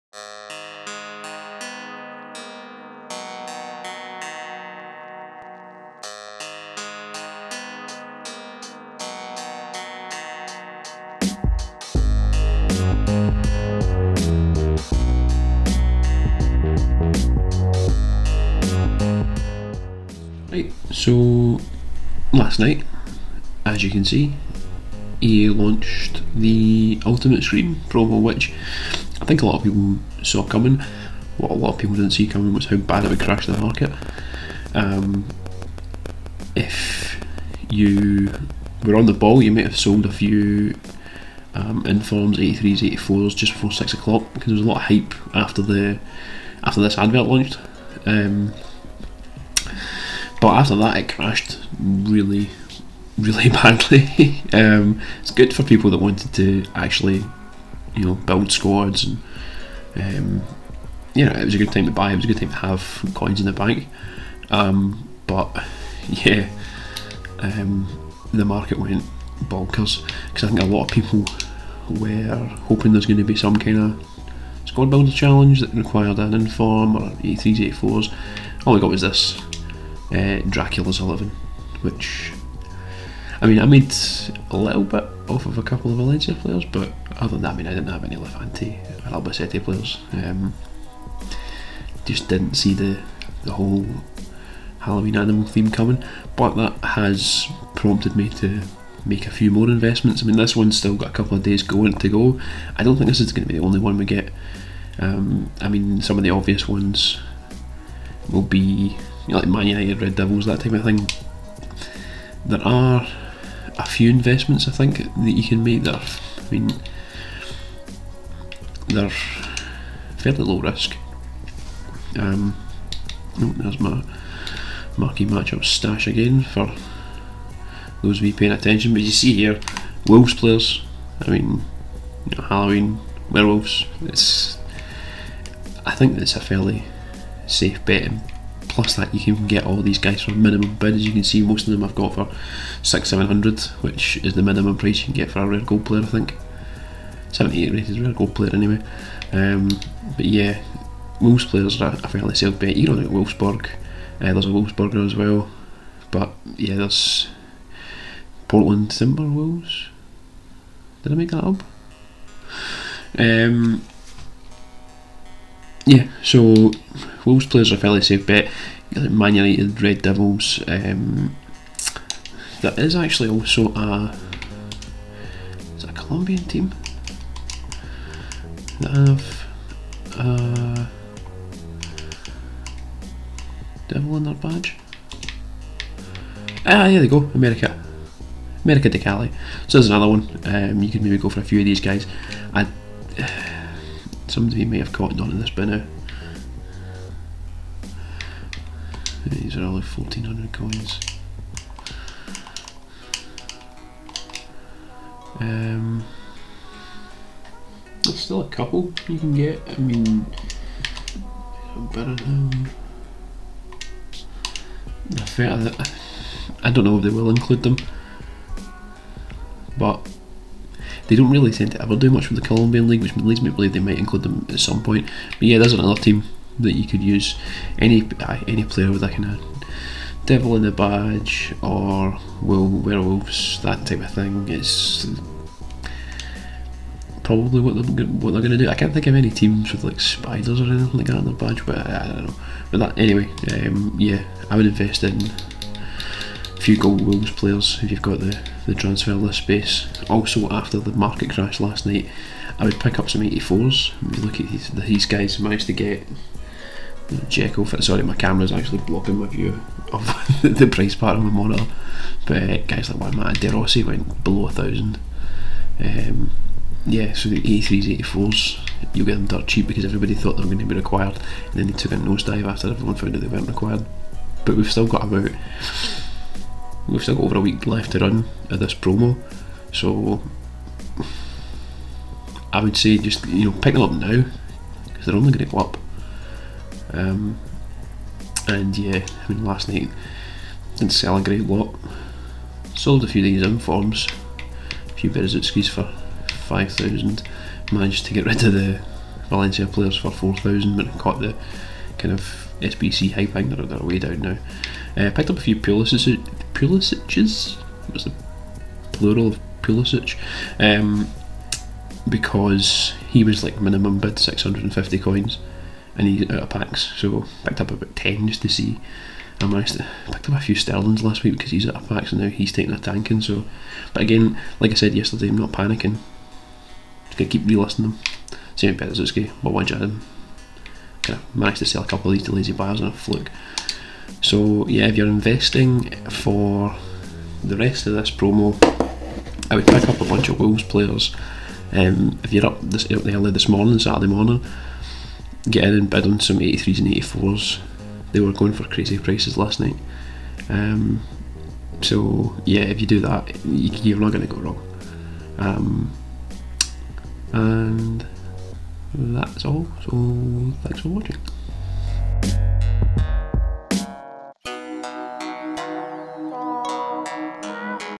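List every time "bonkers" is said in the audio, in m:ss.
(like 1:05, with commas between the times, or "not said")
1:09.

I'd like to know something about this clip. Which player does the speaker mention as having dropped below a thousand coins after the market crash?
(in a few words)
De Rossi.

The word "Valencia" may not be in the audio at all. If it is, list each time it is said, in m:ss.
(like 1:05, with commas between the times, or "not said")
1:25, 4:59.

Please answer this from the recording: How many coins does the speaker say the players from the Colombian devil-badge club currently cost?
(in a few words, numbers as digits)
1400.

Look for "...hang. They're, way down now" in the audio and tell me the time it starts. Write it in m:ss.
5:03.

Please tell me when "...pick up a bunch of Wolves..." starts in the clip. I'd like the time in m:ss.
5:39.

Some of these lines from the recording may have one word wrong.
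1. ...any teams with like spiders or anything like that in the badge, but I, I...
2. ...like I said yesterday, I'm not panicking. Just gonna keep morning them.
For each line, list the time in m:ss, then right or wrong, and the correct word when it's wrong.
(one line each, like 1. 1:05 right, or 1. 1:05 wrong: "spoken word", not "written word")
1. 3:59 right
2. 5:24 wrong: "relisting", not "morning".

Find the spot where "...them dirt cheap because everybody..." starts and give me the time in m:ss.
4:29.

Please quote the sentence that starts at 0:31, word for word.
What a lot of people didn't see coming was how bad it would crash the market.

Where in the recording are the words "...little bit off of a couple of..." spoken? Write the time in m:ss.
1:24.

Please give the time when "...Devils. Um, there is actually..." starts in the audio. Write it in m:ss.
2:50.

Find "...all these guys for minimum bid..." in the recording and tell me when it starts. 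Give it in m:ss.
2:19.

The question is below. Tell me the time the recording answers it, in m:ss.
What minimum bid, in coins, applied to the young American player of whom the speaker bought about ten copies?
5:14.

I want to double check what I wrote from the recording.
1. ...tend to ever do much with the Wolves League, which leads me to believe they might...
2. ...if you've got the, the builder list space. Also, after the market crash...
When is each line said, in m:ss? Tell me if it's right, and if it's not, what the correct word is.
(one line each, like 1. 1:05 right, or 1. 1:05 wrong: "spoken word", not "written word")
1. 3:41 wrong: "Colombian", not "Wolves"
2. 4:07 wrong: "transfer", not "builder".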